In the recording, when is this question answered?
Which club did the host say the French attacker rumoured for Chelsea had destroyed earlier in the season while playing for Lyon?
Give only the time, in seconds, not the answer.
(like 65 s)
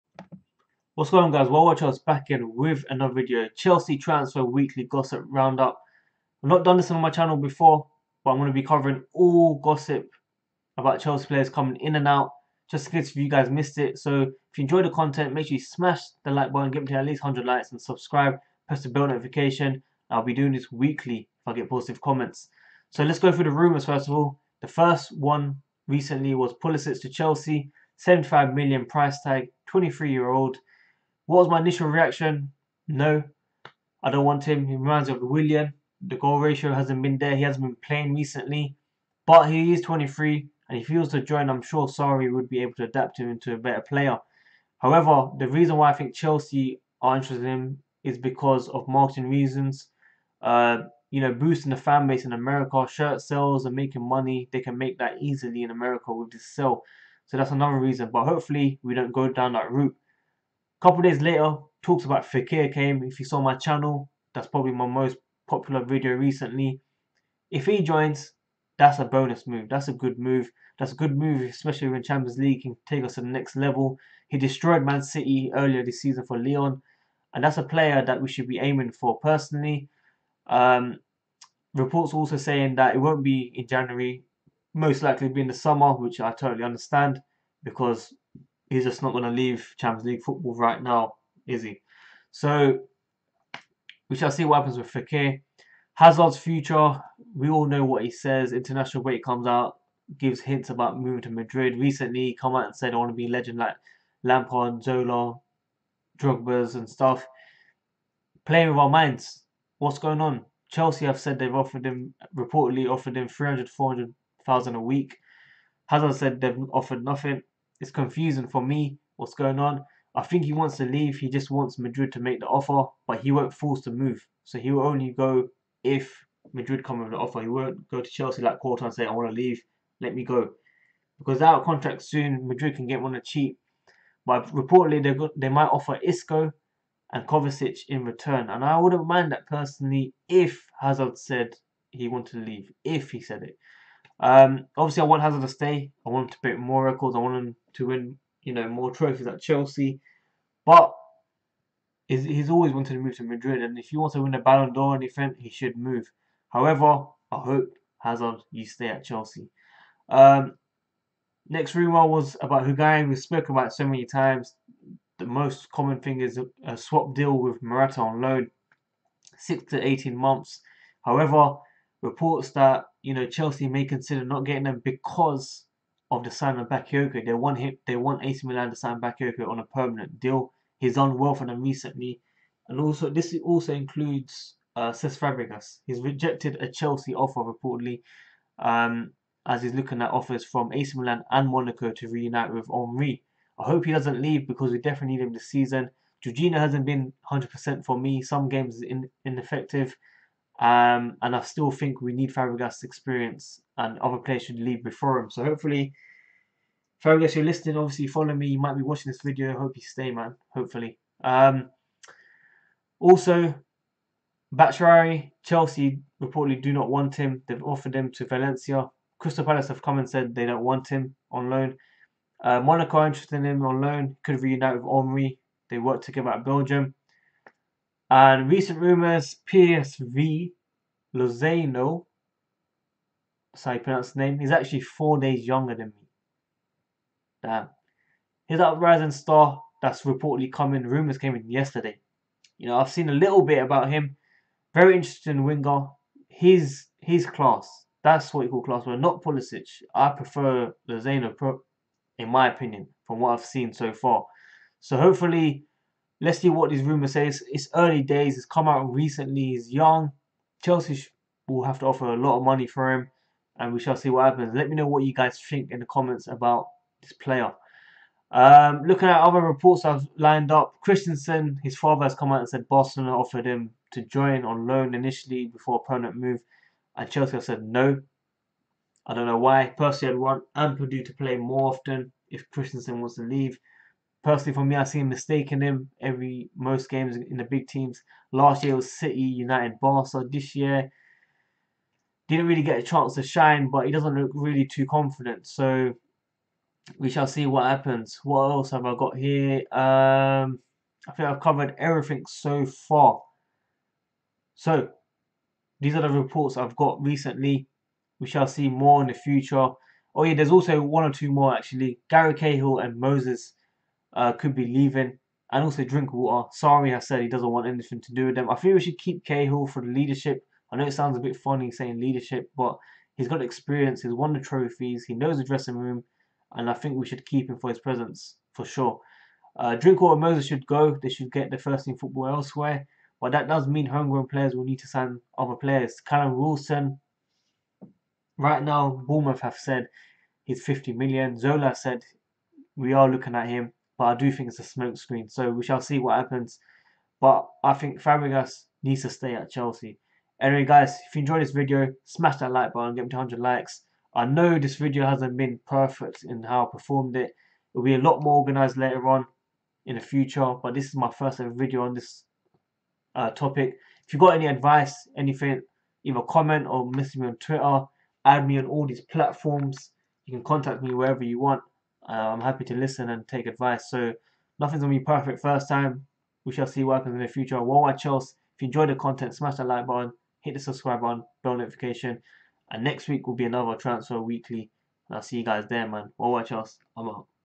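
74 s.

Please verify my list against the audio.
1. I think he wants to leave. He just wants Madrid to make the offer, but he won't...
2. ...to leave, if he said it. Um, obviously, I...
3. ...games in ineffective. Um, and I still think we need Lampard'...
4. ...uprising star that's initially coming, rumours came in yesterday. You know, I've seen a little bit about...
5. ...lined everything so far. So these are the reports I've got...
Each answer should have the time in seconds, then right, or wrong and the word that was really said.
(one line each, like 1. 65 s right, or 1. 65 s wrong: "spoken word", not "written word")
1. 120 s right
2. 142 s right
3. 198 s wrong: "Fabregas", not "Lampard"
4. 238 s wrong: "reportedly", not "initially"
5. 301 s wrong: "covered", not "lined".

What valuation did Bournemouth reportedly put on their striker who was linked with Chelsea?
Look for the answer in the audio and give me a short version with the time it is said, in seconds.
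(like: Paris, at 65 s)
50 million, at 340 s.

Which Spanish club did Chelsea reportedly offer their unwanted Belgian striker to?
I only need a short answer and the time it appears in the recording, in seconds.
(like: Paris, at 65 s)
Valencia, at 218 s.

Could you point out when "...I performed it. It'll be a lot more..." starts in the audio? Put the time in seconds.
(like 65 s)
356 s.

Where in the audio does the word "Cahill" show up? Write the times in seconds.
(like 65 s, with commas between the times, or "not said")
312 s, 319 s.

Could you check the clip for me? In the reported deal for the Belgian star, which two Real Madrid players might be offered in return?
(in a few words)
Isco and Kovacic.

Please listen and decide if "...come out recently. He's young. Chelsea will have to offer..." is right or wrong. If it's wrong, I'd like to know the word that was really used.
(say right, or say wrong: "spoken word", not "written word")
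right.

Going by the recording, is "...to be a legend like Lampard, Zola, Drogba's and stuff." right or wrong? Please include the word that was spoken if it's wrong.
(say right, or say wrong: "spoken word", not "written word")
right.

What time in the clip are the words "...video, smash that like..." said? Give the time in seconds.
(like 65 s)
351 s.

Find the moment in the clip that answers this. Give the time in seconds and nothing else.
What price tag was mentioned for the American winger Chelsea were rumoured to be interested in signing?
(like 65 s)
27 s.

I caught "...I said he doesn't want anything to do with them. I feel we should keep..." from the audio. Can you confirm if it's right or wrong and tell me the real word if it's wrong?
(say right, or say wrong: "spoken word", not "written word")
right.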